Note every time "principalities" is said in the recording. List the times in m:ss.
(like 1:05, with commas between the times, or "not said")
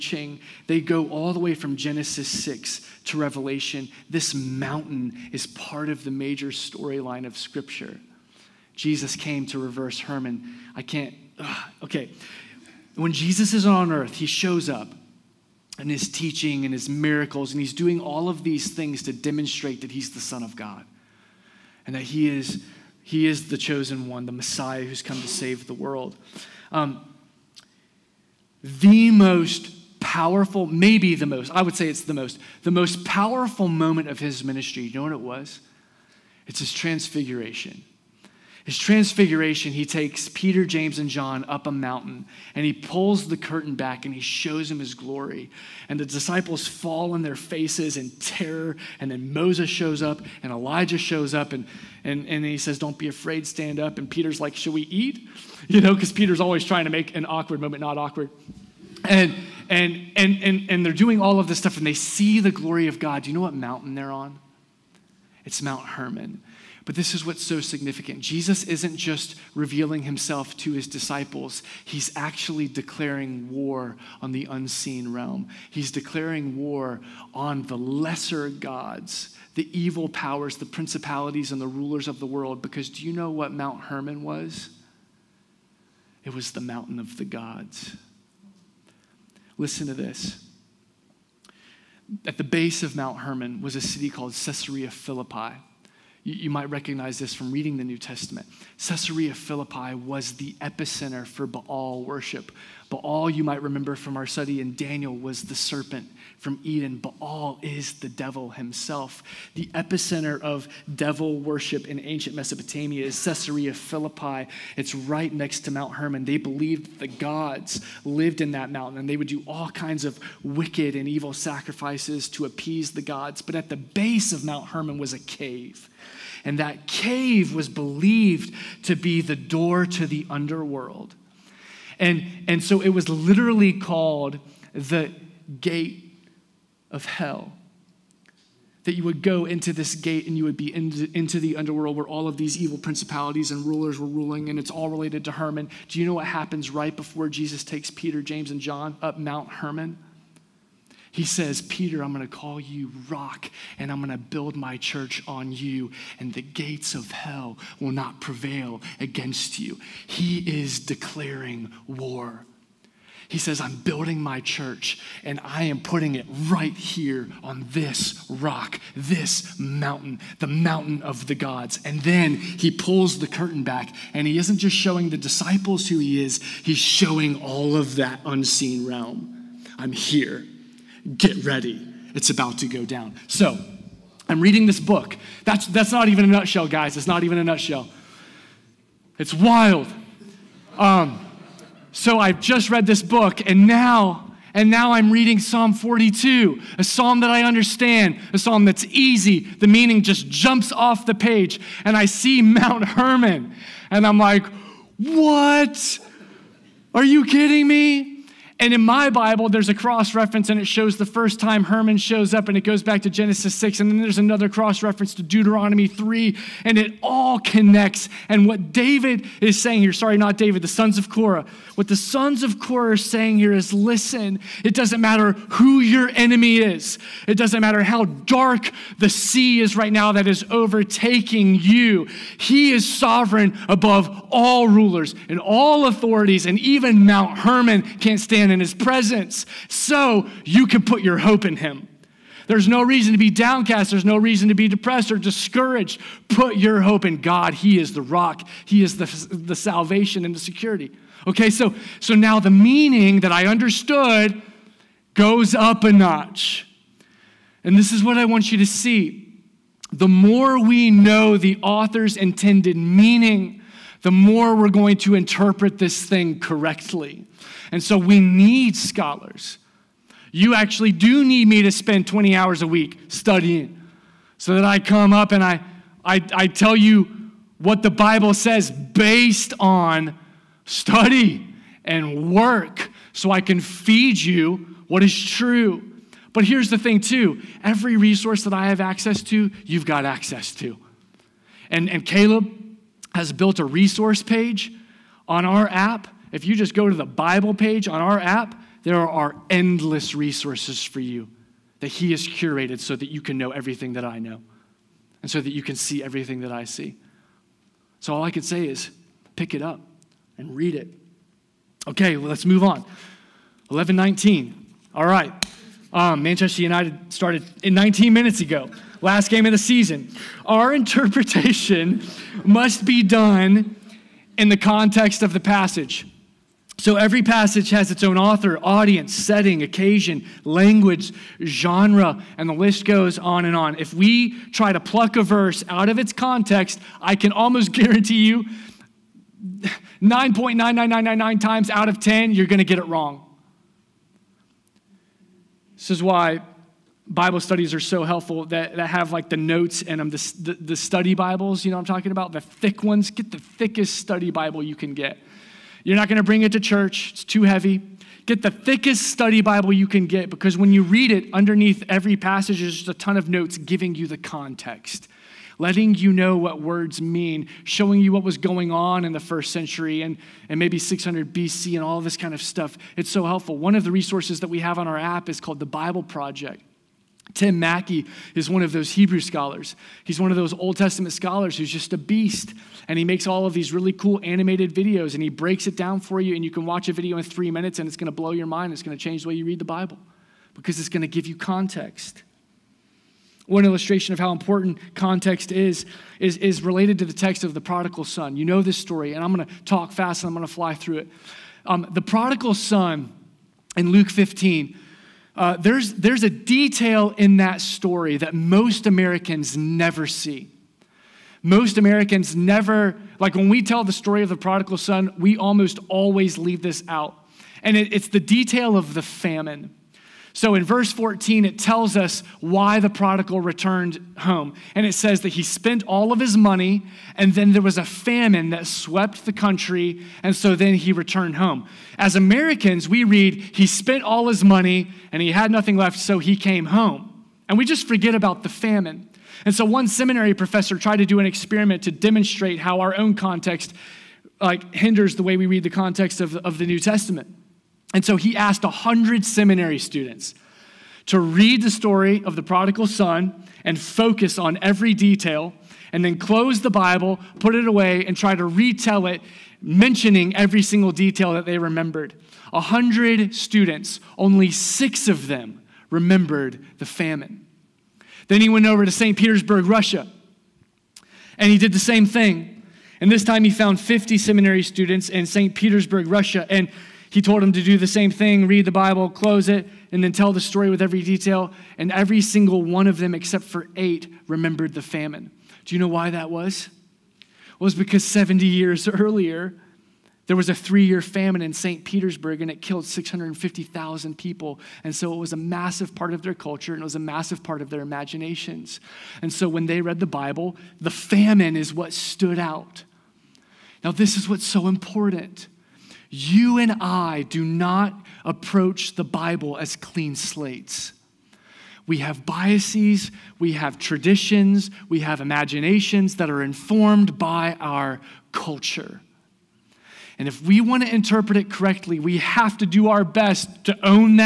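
1:20, 2:22.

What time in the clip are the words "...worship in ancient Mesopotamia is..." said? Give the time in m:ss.
1:51.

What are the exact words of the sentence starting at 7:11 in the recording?
As Americans, we read, he spent all his money, and he had nothing left, so he came home.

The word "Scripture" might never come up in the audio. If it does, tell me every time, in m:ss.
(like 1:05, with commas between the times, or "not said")
0:07.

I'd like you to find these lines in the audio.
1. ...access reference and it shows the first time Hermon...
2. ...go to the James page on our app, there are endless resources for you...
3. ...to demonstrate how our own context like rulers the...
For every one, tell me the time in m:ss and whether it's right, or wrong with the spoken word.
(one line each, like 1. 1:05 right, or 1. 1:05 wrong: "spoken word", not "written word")
1. 3:29 wrong: "cross", not "access"
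2. 4:56 wrong: "Bible", not "James"
3. 7:21 wrong: "hinders", not "rulers".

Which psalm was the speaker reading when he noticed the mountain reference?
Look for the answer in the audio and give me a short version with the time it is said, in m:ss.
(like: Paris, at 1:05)
Psalm 42, at 3:15.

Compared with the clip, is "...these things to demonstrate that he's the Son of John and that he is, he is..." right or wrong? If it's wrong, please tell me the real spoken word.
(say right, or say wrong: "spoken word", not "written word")
wrong: "God", not "John".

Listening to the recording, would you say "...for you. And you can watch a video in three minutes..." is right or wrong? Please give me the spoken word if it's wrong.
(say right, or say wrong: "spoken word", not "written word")
right.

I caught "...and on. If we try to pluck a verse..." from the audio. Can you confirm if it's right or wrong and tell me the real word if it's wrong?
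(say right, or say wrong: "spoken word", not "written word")
right.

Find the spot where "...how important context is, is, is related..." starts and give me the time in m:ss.
6:34.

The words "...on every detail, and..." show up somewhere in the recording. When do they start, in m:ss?
7:34.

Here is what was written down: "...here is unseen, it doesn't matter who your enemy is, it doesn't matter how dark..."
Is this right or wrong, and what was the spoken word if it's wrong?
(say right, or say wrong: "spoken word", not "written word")
wrong: "listen", not "unseen".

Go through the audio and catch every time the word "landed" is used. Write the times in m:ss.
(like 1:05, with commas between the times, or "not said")
not said.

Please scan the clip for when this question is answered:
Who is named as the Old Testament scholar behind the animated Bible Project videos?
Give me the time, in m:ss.
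6:17.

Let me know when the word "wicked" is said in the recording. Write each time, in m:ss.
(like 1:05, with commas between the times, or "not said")
2:00.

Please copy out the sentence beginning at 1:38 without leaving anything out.
Caesarea Philippi was the epicenter for Baal worship.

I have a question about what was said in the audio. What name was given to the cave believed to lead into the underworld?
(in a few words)
the gate of hell.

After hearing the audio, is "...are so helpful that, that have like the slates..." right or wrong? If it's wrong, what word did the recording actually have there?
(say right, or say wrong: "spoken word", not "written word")
wrong: "notes", not "slates".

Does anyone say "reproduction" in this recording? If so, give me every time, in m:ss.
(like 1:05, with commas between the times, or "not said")
not said.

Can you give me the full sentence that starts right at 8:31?
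We have biases, we have traditions, we have imaginations that are informed by our culture.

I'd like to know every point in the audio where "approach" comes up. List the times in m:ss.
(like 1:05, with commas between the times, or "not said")
8:28.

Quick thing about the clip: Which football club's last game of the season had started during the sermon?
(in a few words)
Manchester United.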